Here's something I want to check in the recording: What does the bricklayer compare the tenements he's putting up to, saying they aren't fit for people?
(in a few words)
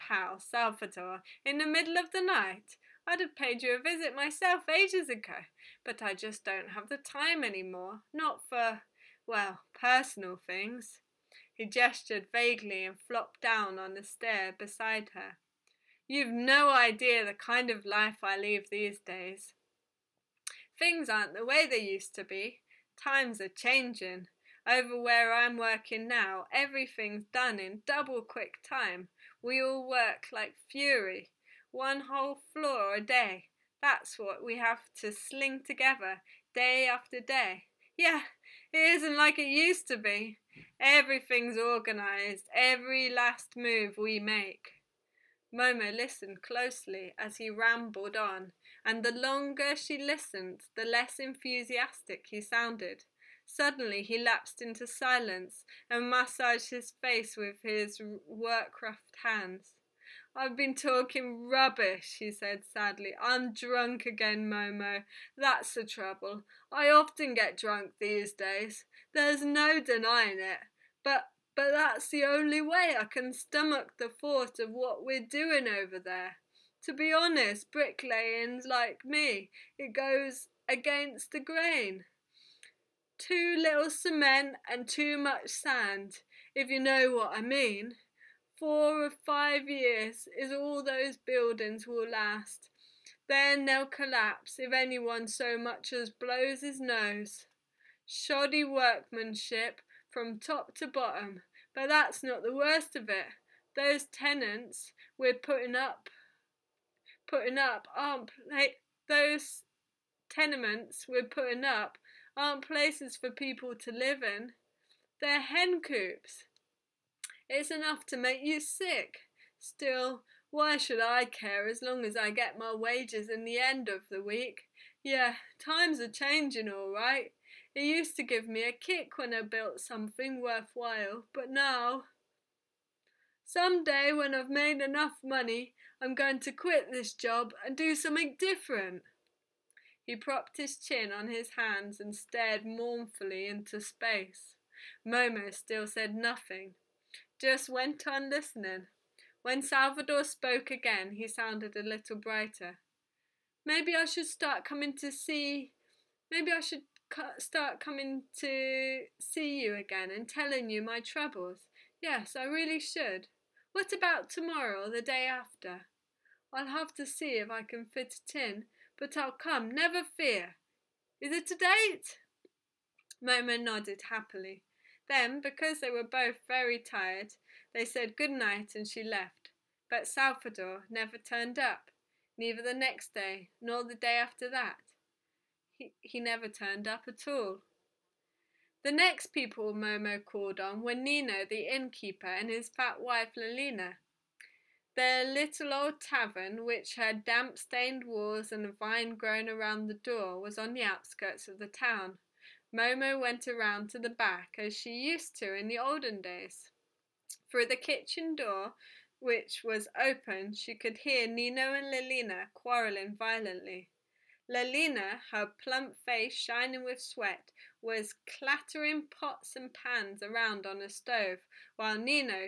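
Hen coops.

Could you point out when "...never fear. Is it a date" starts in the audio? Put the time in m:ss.
2:49.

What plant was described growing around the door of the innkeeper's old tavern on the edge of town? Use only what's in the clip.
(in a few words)
A vine.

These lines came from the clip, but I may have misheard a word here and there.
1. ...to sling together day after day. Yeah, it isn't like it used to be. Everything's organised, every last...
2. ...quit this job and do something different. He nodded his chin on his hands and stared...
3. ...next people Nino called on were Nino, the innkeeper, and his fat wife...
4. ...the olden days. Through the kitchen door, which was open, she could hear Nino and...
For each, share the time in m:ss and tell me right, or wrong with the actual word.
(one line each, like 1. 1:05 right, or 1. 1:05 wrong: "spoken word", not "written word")
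1. 0:35 right
2. 2:16 wrong: "propped", not "nodded"
3. 3:08 wrong: "Momo", not "Nino"
4. 3:25 right.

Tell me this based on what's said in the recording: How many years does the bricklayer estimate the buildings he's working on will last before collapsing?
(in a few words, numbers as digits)
4 or 5.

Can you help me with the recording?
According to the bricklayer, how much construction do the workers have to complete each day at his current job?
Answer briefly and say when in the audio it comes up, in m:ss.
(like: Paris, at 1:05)
One whole floor, at 0:31.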